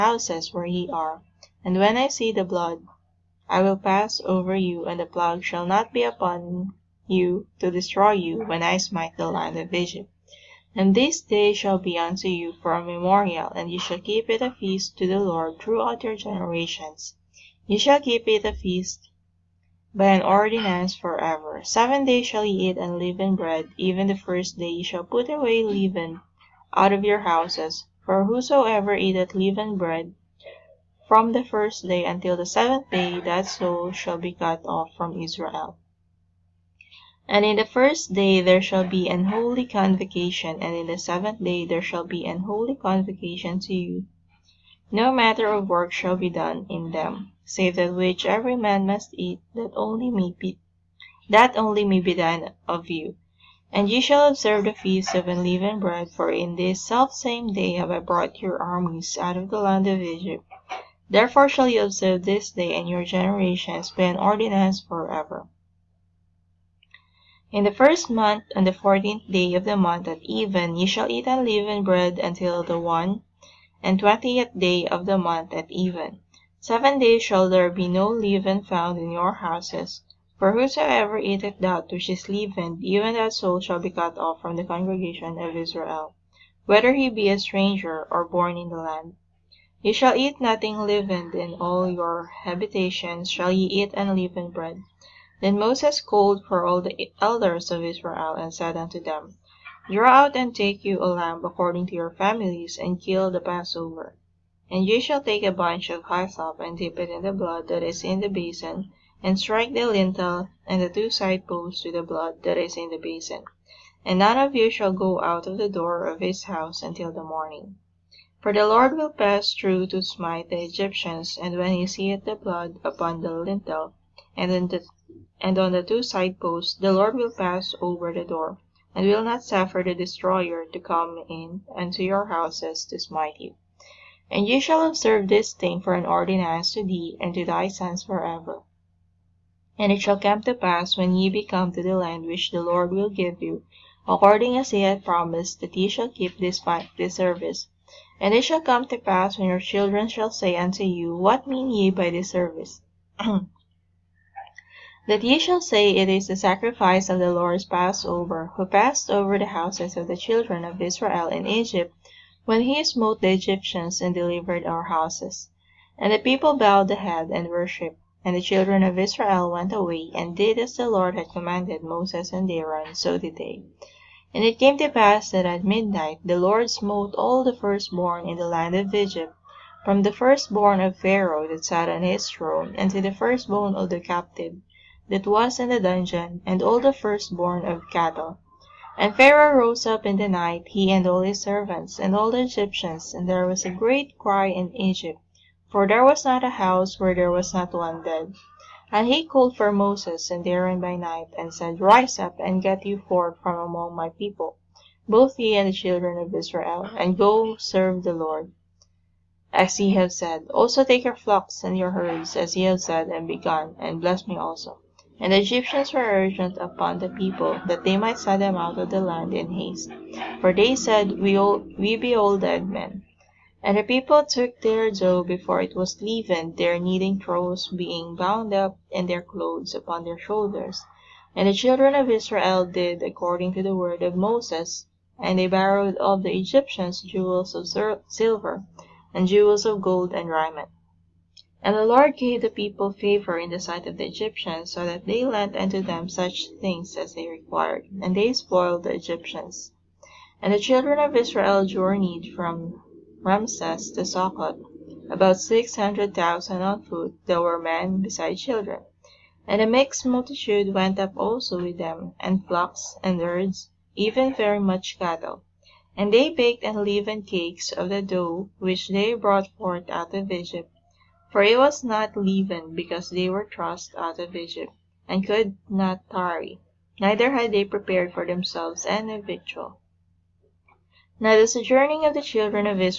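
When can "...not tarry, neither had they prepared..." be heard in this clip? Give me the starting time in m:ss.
4:35.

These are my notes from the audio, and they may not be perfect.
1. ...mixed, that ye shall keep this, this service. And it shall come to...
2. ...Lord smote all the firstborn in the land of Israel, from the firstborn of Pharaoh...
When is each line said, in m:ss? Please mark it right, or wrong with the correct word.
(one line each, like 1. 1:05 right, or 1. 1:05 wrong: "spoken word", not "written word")
1. 2:25 wrong: "promised", not "mixed"
2. 2:56 wrong: "Egypt", not "Israel".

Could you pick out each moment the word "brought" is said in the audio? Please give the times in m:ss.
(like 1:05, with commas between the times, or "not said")
0:57, 4:29.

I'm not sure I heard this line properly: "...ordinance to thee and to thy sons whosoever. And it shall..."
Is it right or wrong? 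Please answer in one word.
wrong.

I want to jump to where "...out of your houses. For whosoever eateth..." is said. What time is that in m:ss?
0:26.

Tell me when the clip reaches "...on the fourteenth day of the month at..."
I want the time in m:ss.
1:08.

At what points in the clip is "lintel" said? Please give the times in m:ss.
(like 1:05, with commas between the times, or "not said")
1:49, 2:03.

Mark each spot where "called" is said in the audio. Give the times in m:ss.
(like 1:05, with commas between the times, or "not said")
1:36, 3:19.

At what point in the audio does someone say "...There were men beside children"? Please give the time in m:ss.
4:17.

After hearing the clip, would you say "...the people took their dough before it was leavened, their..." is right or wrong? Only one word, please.
right.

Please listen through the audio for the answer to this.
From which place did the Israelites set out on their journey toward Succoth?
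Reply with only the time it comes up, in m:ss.
4:13.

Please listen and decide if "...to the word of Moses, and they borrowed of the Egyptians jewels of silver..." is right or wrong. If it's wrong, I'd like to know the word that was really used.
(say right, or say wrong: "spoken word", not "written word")
right.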